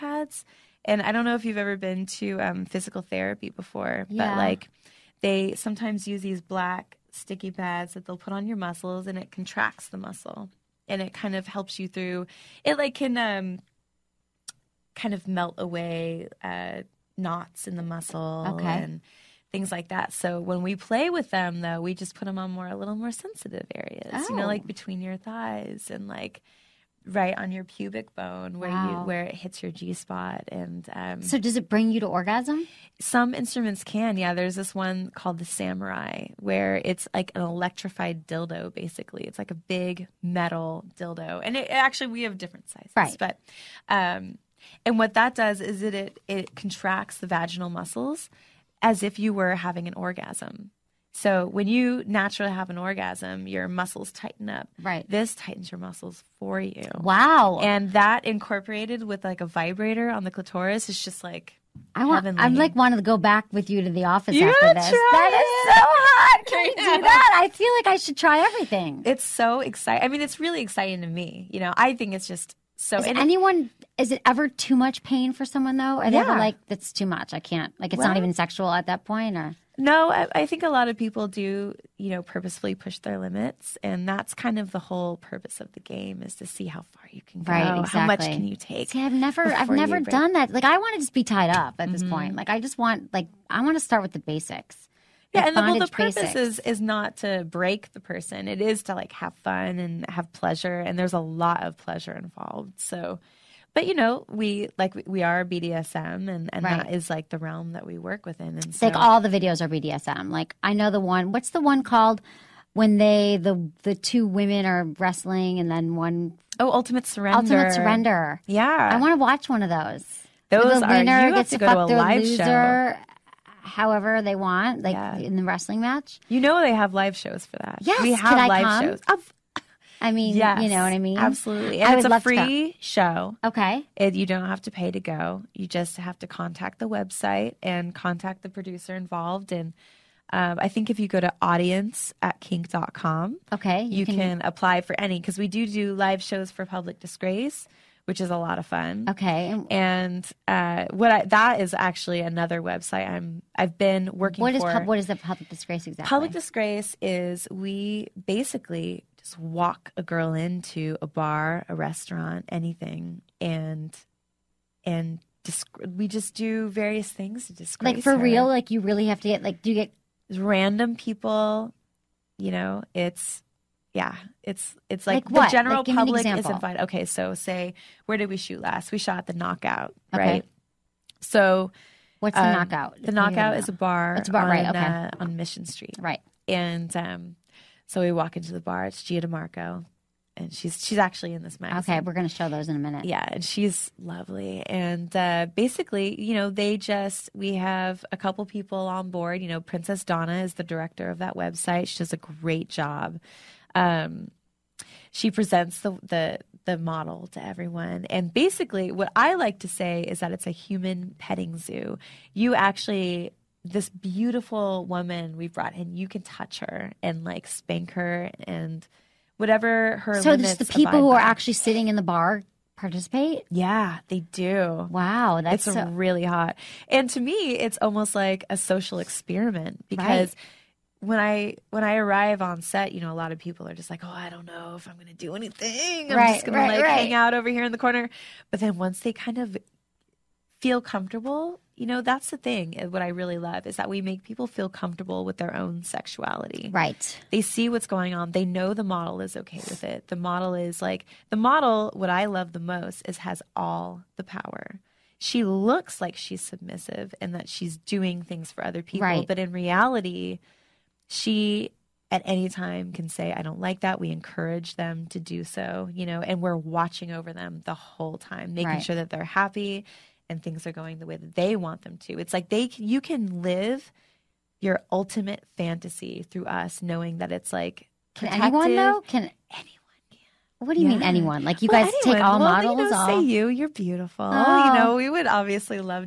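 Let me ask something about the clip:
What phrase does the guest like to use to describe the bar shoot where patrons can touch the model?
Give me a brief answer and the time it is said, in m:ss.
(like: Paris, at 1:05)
Human petting zoo, at 3:30.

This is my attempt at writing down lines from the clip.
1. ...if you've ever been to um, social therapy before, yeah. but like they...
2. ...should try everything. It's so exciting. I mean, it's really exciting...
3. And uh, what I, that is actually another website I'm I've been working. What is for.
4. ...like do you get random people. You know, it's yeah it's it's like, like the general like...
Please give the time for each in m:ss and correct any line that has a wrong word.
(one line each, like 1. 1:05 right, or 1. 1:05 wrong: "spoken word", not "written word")
1. 0:01 wrong: "physical", not "social"
2. 1:07 right
3. 2:29 right
4. 2:49 right.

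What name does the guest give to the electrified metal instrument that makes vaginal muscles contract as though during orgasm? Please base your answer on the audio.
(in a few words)
Samurai.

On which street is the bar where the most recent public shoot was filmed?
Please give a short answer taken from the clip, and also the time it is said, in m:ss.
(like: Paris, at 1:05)
Mission Street, at 3:05.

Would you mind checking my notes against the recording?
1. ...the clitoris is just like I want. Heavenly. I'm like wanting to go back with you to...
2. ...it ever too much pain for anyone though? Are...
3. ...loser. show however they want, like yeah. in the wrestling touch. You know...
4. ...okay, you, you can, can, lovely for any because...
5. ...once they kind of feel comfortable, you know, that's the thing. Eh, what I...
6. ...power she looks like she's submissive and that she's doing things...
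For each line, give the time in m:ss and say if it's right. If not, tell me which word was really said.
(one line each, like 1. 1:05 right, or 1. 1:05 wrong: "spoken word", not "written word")
1. 1:00 right
2. 1:14 wrong: "someone", not "anyone"
3. 2:02 wrong: "match", not "touch"
4. 2:23 wrong: "apply", not "lovely"
5. 3:58 right
6. 4:14 right.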